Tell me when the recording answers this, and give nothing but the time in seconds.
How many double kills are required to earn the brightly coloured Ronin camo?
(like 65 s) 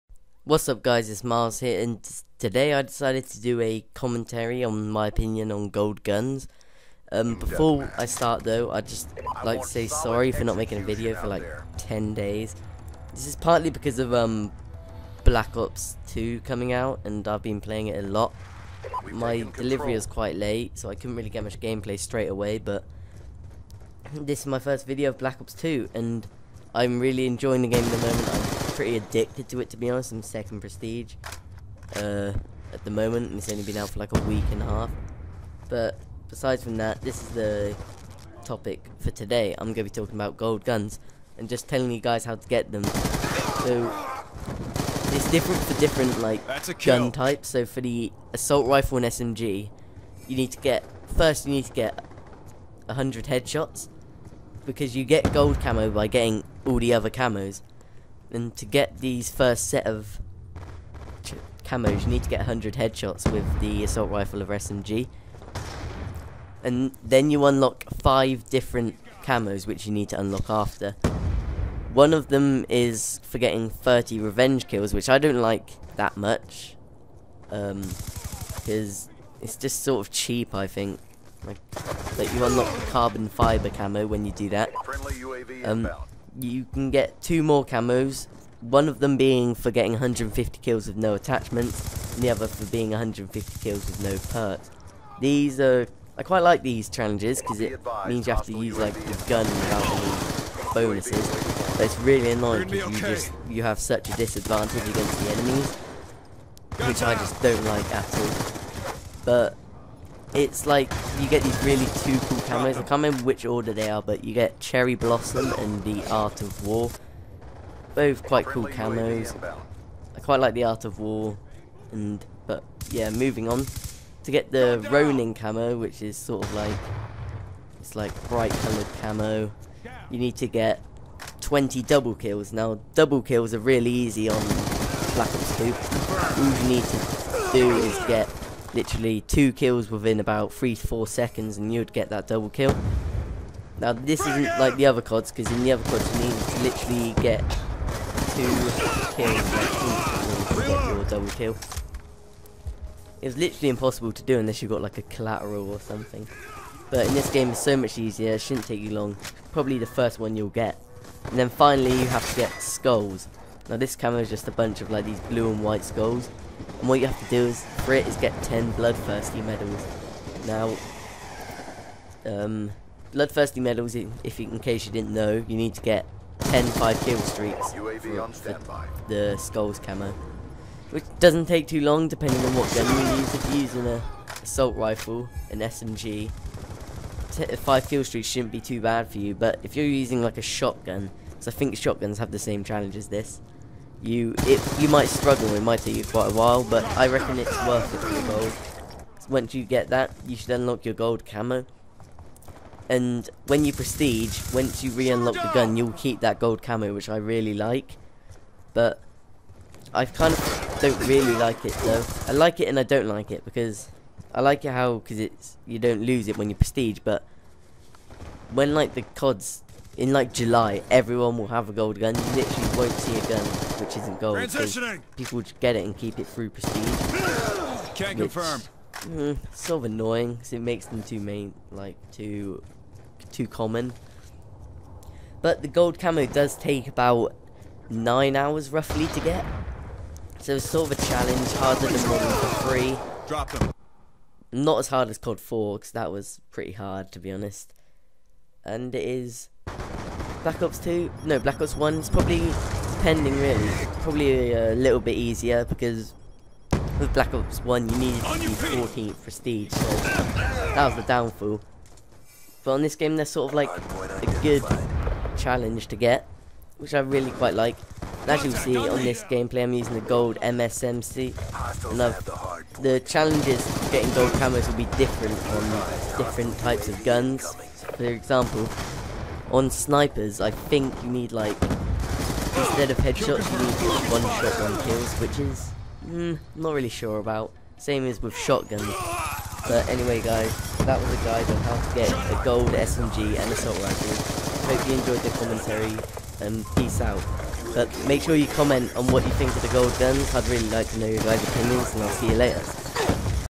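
131 s.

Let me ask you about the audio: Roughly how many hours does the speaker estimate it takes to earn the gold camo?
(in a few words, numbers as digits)
9.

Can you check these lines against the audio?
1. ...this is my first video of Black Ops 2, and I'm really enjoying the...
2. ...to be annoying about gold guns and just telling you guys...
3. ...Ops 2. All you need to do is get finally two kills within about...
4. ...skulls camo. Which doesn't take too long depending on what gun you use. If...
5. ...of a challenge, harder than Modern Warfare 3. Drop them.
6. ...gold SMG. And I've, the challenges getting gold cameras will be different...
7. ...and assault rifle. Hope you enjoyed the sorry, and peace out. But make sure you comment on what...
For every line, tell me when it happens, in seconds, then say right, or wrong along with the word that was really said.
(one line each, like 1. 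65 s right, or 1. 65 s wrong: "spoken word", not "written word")
1. 24 s right
2. 39 s wrong: "talking", not "annoying"
3. 135 s wrong: "literally", not "finally"
4. 179 s right
5. 240 s right
6. 270 s wrong: "MSMC", not "SMG"
7. 293 s wrong: "commentary", not "sorry".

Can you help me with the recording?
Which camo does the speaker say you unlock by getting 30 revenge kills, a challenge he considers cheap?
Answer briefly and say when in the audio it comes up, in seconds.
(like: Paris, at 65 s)
Carbon fiber, at 82 s.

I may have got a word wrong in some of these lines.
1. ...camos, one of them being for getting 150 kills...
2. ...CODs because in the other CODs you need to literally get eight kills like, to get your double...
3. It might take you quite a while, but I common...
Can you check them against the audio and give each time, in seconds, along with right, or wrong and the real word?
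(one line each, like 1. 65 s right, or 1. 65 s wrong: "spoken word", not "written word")
1. 87 s right
2. 145 s wrong: "two", not "eight"
3. 195 s wrong: "reckon", not "common".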